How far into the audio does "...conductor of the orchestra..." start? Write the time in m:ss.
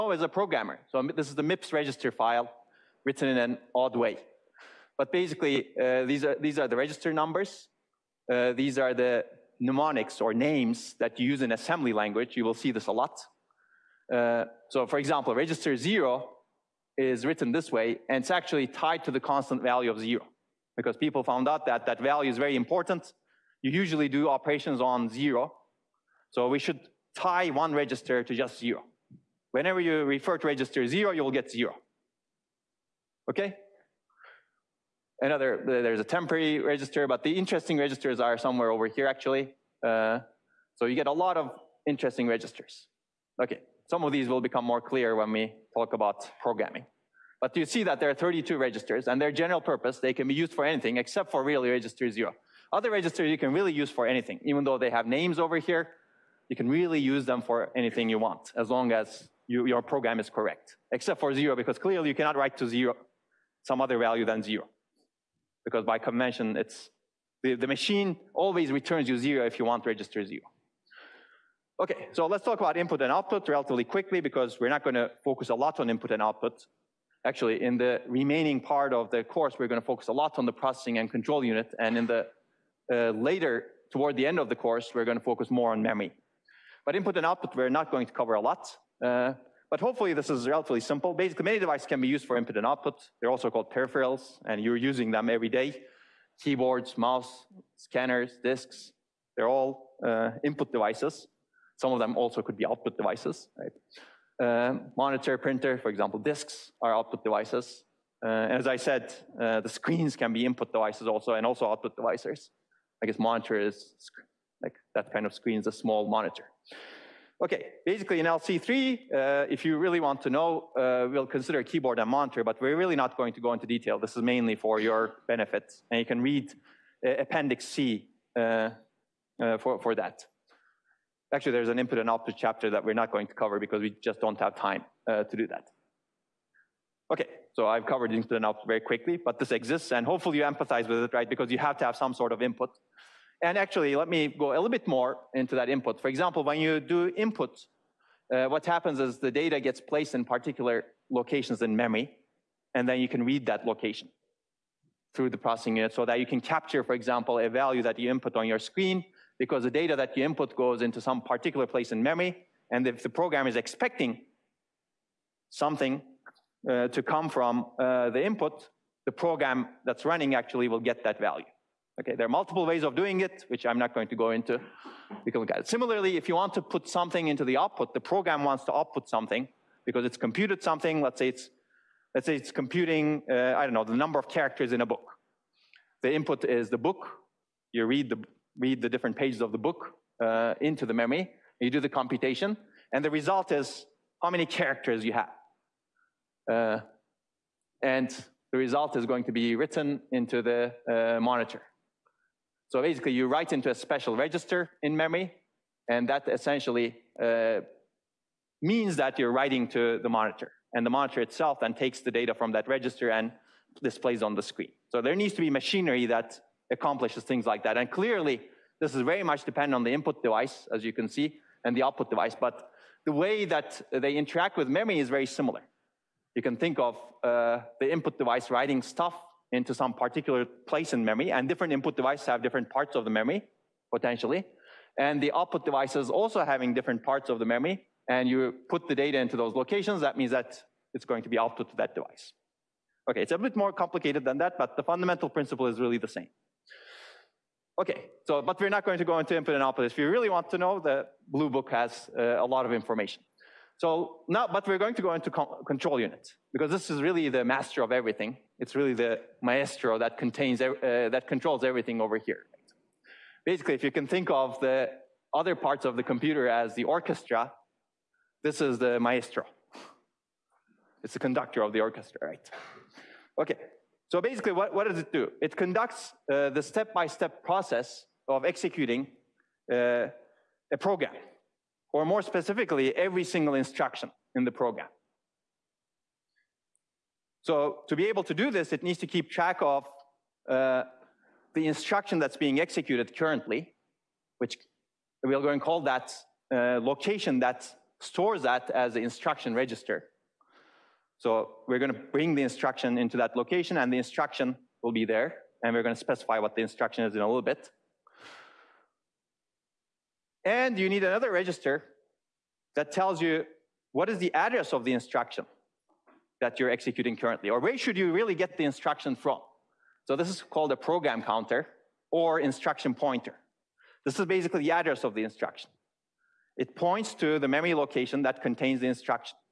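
4:31.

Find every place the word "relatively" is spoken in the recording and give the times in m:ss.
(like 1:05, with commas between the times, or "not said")
1:13, 1:30.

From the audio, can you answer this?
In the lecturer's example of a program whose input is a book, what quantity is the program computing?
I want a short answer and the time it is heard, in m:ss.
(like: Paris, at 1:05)
number of characters, at 3:03.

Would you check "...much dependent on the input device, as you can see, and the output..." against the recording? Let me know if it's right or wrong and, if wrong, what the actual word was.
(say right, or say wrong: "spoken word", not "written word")
right.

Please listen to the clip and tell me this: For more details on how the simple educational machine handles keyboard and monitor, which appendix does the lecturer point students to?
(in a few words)
Appendix C.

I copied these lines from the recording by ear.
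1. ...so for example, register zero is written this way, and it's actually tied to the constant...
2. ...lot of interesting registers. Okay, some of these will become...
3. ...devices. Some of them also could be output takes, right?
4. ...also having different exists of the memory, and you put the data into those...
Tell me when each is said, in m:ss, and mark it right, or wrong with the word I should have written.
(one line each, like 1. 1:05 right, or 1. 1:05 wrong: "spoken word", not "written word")
1. 0:14 right
2. 0:41 right
3. 1:40 wrong: "devices", not "takes"
4. 3:56 wrong: "parts", not "exists".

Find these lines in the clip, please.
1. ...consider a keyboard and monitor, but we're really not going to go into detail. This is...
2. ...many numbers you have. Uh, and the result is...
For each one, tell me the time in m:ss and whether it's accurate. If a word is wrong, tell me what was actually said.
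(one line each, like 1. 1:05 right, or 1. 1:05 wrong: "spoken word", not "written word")
1. 2:01 right
2. 3:14 wrong: "characters", not "numbers".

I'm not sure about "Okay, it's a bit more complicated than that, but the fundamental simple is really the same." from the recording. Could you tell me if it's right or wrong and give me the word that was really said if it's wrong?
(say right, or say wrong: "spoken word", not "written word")
wrong: "principle", not "simple".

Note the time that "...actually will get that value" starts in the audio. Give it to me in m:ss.
2:50.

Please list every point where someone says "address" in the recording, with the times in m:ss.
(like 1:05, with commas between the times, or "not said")
5:14, 5:24.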